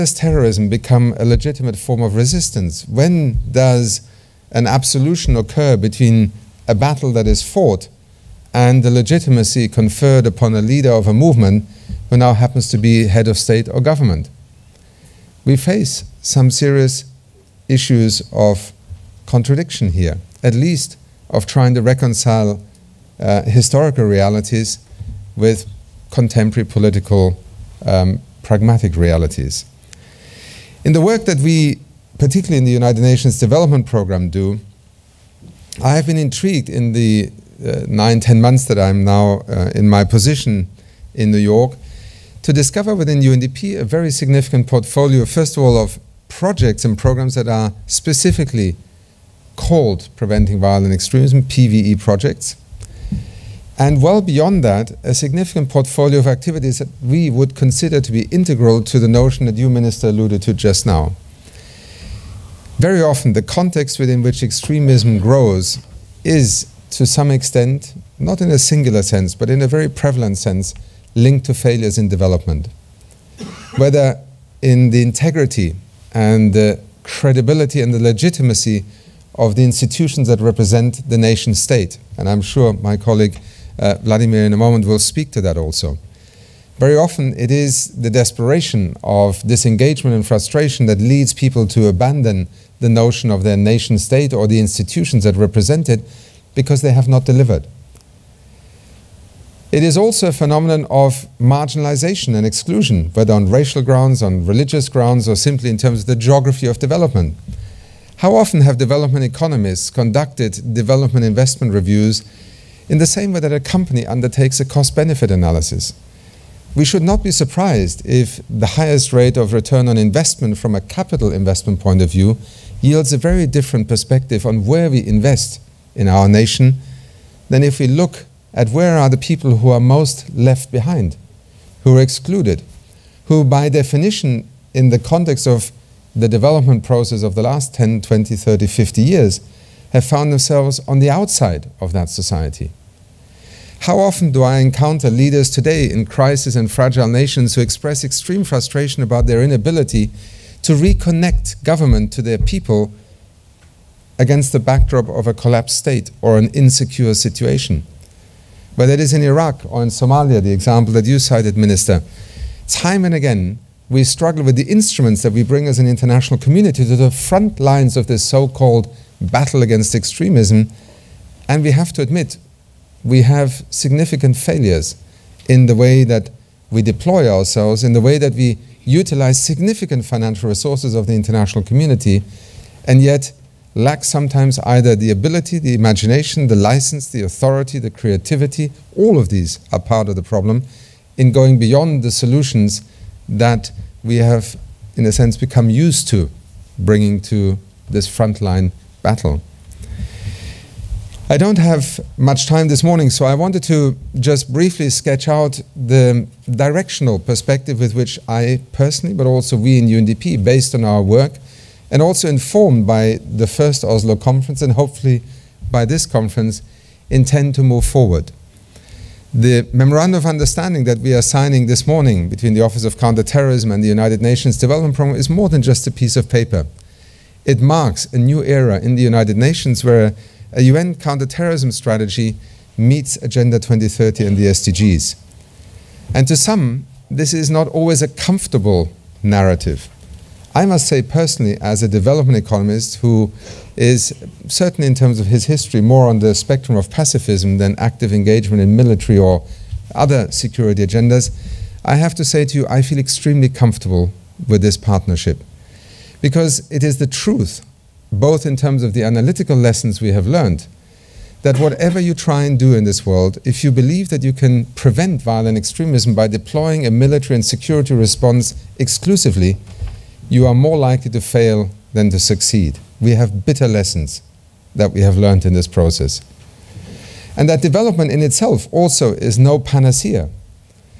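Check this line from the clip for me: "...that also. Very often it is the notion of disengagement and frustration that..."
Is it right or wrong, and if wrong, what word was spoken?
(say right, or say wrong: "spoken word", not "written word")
wrong: "desperation", not "notion".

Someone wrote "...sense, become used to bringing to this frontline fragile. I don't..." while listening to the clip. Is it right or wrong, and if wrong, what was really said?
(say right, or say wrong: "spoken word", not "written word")
wrong: "battle", not "fragile".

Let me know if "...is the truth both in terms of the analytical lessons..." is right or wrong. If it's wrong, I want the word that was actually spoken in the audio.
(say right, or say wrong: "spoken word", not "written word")
right.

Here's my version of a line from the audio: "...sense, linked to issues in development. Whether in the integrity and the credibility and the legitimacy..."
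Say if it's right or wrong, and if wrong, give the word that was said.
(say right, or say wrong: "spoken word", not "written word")
wrong: "failures", not "issues".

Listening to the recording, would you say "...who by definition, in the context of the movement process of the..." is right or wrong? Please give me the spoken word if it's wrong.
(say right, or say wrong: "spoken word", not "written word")
wrong: "development", not "movement".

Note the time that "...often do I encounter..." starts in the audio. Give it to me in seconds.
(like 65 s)
143 s.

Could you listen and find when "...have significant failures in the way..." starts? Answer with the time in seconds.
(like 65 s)
173 s.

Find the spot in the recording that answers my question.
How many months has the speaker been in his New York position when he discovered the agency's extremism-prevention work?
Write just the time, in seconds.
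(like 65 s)
37 s.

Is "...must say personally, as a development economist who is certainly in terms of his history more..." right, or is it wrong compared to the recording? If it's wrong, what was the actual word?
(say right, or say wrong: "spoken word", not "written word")
right.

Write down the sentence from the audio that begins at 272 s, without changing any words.
We have bitter lessons that we have learned in this process.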